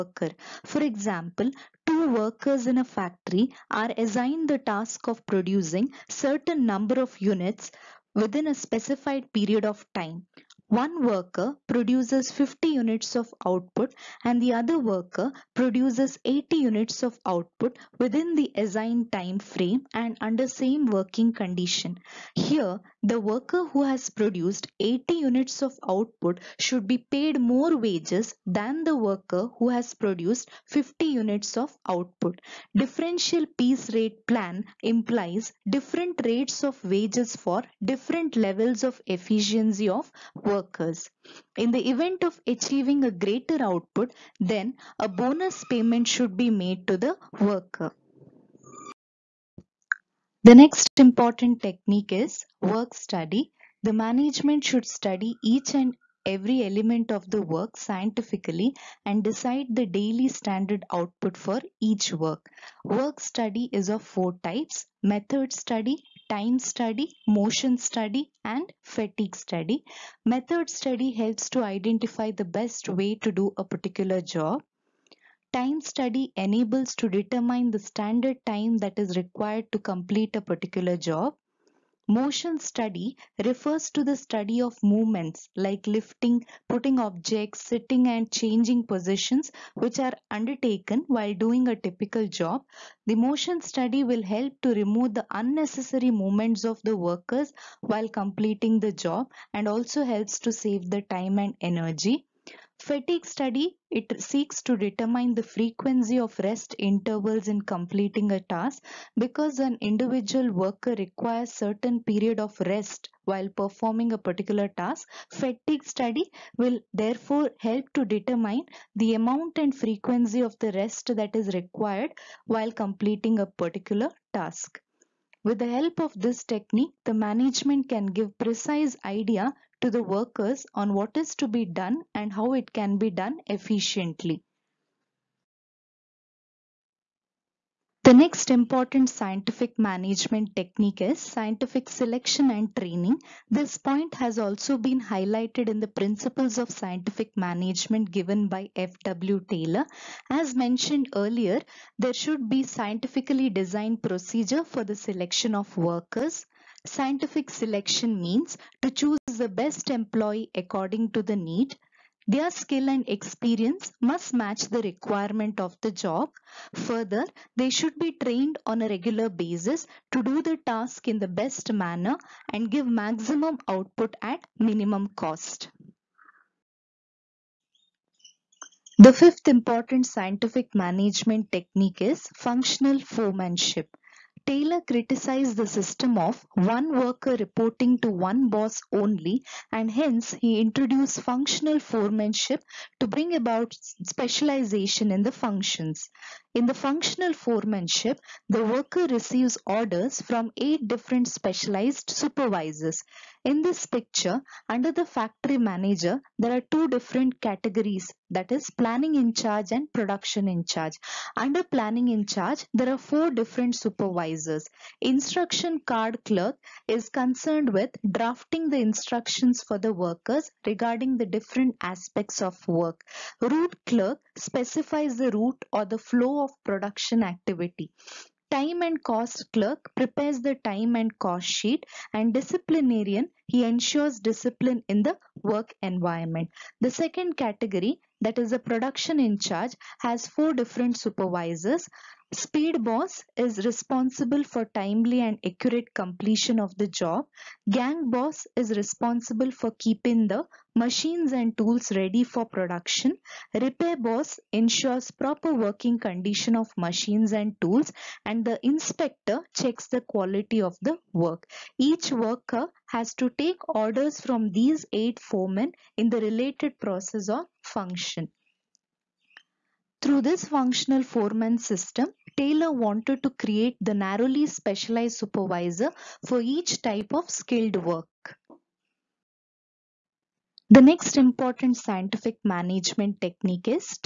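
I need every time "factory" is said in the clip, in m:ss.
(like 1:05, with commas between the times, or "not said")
0:02, 3:25.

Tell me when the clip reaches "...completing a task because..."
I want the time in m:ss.
1:47.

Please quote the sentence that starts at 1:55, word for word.
Fatigue study will therefore help to determine the amount and frequency of the rest that is required while completing a particular task.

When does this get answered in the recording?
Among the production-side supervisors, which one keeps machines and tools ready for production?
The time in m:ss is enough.
4:07.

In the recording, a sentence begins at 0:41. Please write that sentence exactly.
In the event of achieving a greater output, then a bonus payment should be made to the worker.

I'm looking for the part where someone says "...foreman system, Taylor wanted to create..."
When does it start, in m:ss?
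4:31.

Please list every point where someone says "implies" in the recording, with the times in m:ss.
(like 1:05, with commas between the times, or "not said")
0:34.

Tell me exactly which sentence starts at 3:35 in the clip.
Instruction card clerk is concerned with drafting the instructions for the workers regarding the different aspects of work.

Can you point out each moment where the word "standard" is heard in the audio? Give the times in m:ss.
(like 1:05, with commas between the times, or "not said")
1:00, 1:17.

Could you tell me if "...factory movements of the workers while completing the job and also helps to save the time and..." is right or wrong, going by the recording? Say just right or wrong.
wrong.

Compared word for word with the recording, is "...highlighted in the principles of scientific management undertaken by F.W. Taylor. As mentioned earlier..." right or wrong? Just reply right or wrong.
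wrong.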